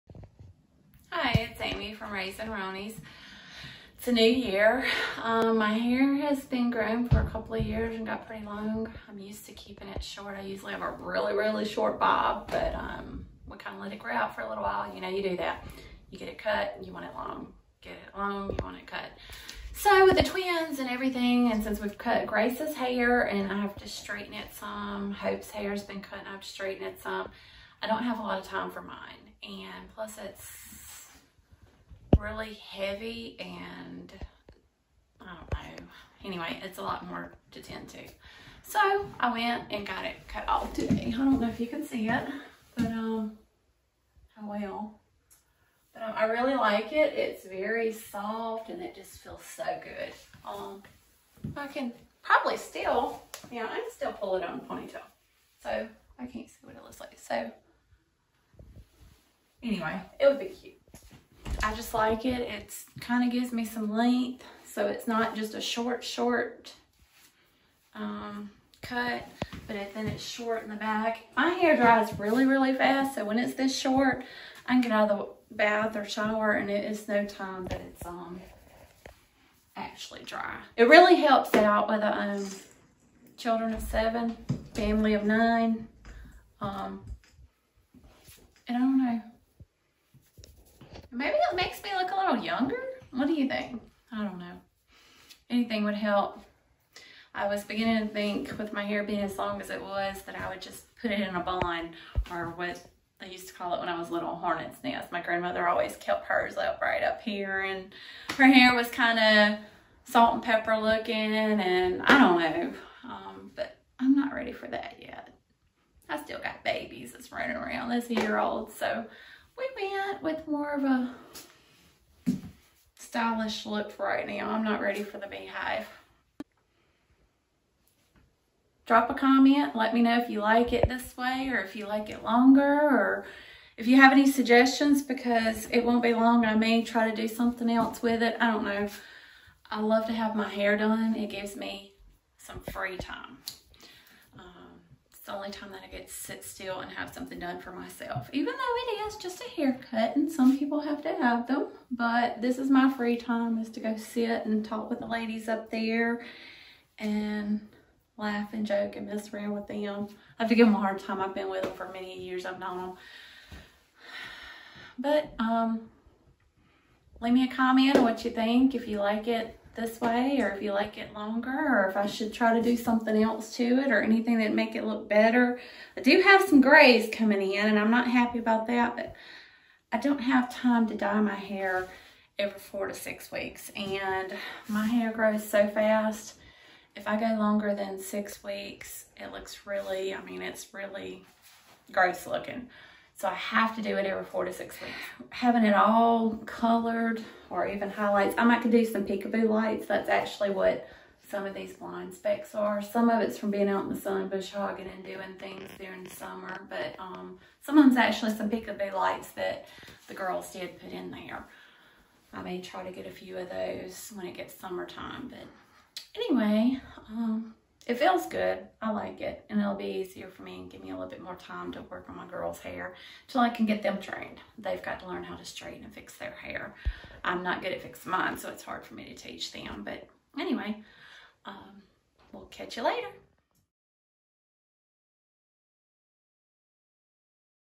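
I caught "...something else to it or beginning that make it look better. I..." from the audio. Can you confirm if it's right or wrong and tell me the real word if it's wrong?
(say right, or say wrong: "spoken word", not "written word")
wrong: "anything", not "beginning".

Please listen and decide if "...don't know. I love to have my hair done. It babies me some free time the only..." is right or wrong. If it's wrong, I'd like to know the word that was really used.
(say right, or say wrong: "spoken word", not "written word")
wrong: "gives", not "babies".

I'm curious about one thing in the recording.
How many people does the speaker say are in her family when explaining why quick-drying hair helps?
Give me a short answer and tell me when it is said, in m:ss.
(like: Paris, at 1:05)
9, at 1:25.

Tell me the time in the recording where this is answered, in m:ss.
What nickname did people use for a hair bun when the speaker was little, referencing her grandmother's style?
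1:44.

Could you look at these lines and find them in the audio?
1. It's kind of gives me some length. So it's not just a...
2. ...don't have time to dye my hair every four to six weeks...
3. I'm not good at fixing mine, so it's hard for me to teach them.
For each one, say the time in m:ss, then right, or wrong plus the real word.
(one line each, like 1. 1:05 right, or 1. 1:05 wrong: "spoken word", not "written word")
1. 1:02 right
2. 2:59 right
3. 3:47 right.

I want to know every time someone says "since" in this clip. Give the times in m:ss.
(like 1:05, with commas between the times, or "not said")
0:21.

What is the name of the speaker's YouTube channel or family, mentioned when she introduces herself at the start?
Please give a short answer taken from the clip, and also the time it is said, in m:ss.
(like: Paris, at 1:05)
Raising Roneys, at 0:02.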